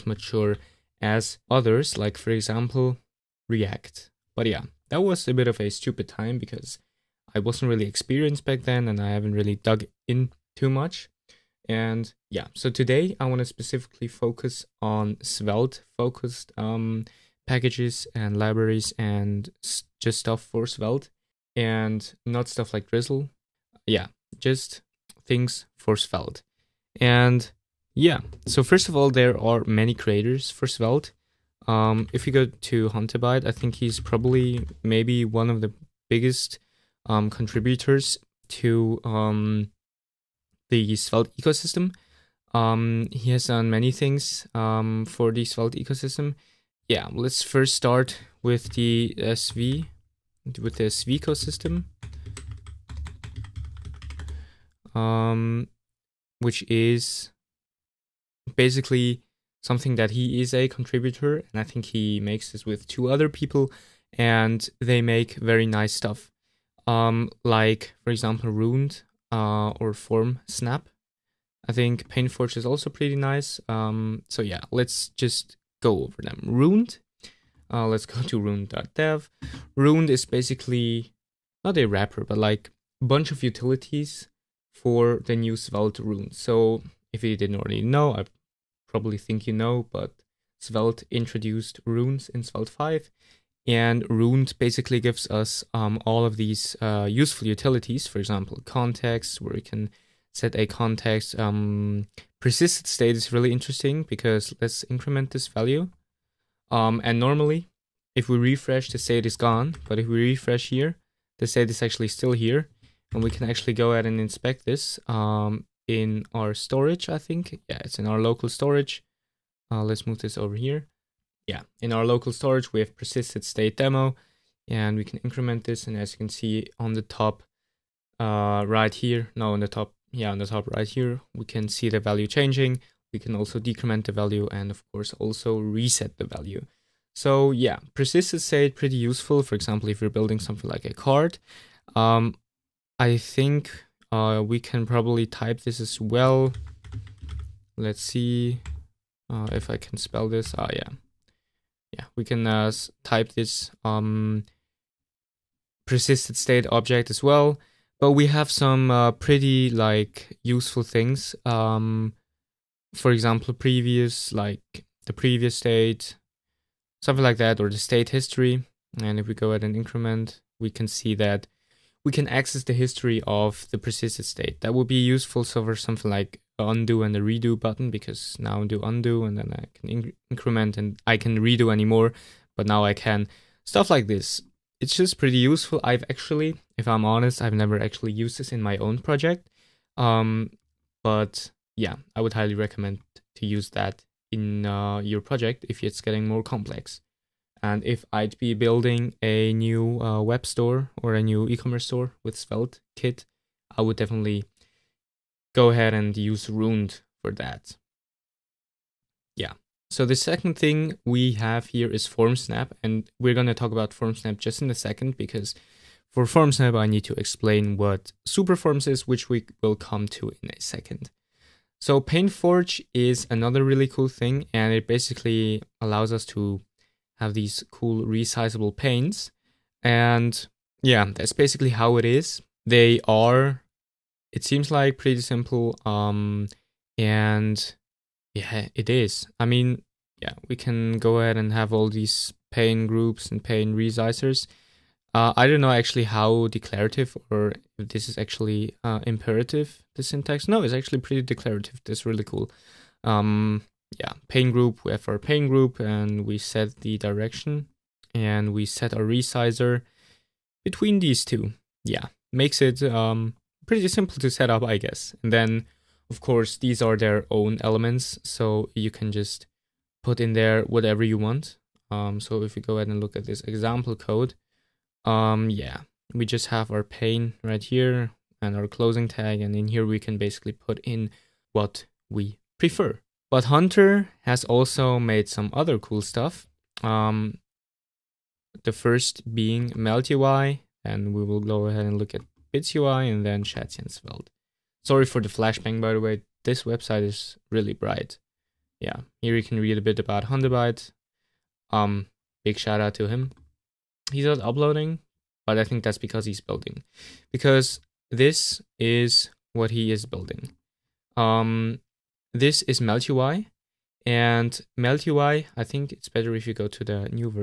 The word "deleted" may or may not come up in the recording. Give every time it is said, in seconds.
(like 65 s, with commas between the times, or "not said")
not said.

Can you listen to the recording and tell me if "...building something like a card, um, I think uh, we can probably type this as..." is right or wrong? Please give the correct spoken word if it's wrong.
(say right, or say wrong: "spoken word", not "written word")
right.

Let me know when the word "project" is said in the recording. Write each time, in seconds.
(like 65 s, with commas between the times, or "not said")
188 s, 195 s.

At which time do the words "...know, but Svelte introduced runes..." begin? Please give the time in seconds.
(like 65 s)
89 s.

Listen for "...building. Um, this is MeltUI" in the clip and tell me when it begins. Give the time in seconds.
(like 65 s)
310 s.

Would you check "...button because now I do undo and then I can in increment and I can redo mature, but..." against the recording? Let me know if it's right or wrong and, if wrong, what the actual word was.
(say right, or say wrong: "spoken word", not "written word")
wrong: "anymore", not "mature".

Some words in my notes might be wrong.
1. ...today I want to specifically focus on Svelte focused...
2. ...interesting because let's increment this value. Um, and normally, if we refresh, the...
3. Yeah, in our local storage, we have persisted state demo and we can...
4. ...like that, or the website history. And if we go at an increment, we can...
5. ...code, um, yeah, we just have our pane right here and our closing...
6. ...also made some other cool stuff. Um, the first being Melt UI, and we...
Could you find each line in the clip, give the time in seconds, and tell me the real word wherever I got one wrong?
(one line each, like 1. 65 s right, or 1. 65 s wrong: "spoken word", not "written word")
1. 12 s right
2. 103 s right
3. 121 s right
4. 167 s wrong: "state", not "website"
5. 273 s right
6. 284 s right.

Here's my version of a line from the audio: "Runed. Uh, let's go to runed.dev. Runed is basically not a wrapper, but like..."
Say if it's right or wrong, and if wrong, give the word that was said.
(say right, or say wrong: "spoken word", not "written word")
right.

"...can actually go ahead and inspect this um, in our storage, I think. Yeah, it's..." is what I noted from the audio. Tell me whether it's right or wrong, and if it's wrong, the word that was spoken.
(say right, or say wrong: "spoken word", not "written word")
right.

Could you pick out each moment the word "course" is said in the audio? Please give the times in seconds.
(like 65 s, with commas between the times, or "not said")
134 s, 266 s.